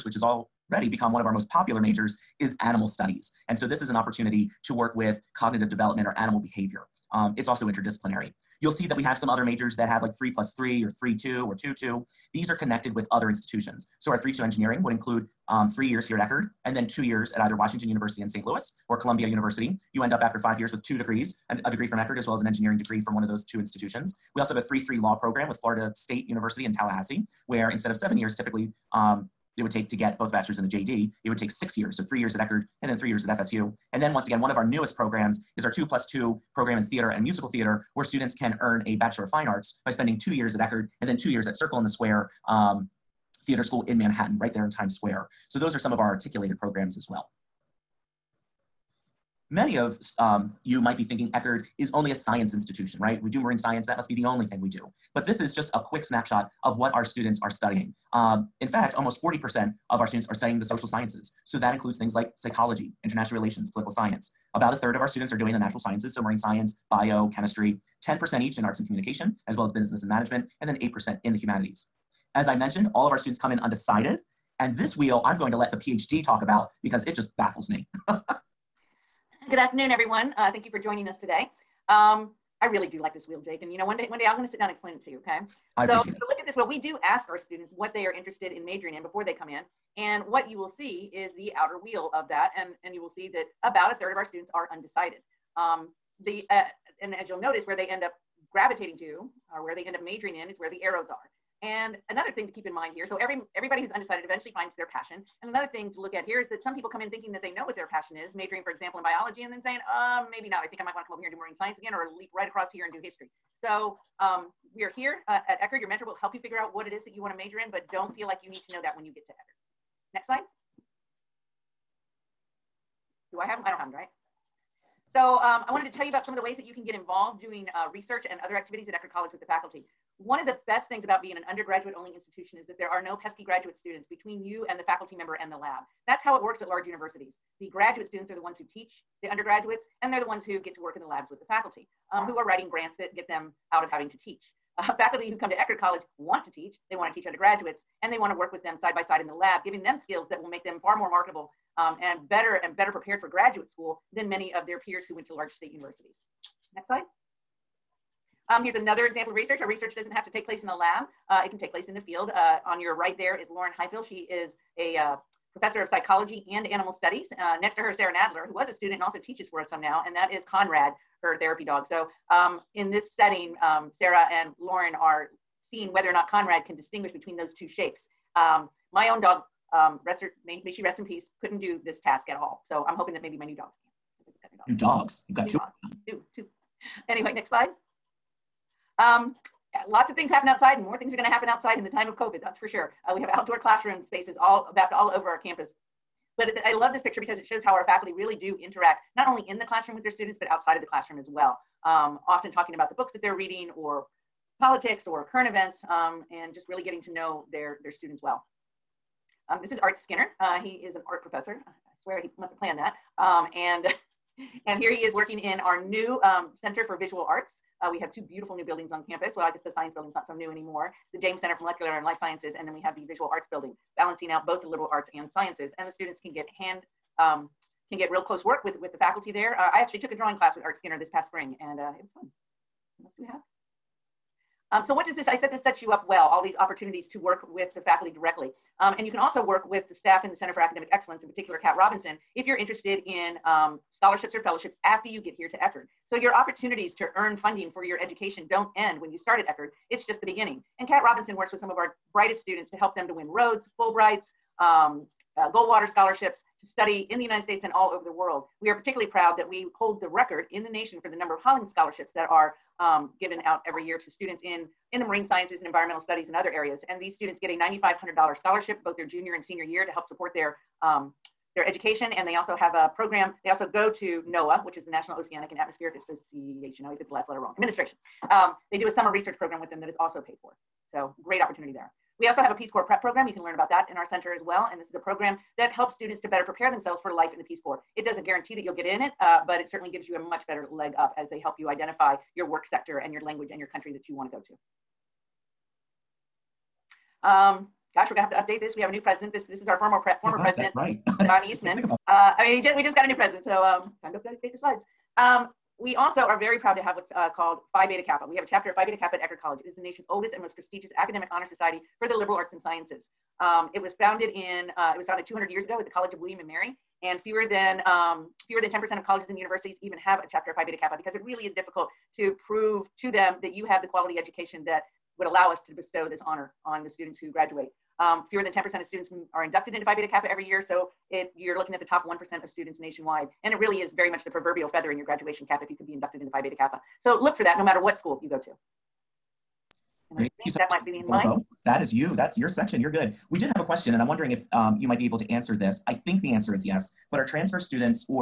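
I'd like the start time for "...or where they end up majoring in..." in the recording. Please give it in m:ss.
1:39.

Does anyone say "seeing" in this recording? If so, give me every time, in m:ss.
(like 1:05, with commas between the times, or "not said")
2:55.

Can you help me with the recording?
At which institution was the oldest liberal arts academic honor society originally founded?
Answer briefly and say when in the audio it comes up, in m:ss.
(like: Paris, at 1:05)
College of William and Mary, at 5:15.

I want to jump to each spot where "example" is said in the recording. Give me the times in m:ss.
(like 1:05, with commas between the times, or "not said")
1:48, 2:39.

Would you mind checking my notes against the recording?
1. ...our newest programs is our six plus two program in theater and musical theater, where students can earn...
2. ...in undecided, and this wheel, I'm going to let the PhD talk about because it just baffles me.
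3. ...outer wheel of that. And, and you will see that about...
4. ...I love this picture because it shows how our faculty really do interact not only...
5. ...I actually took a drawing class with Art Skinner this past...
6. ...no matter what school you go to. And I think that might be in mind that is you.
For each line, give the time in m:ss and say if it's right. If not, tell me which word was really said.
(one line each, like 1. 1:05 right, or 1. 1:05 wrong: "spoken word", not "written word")
1. 0:34 wrong: "two", not "six"
2. 1:13 right
3. 1:31 right
4. 3:16 right
5. 3:49 right
6. 5:37 right.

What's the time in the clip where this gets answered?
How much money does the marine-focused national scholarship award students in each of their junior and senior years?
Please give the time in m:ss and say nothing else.
4:27.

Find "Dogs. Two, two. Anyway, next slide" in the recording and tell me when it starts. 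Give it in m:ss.
3:05.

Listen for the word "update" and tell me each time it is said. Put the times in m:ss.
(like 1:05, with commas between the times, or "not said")
4:58, 5:04.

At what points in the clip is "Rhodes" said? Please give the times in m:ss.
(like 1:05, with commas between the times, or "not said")
4:13.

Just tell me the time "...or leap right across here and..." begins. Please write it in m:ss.
1:51.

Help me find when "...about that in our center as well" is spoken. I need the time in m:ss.
4:43.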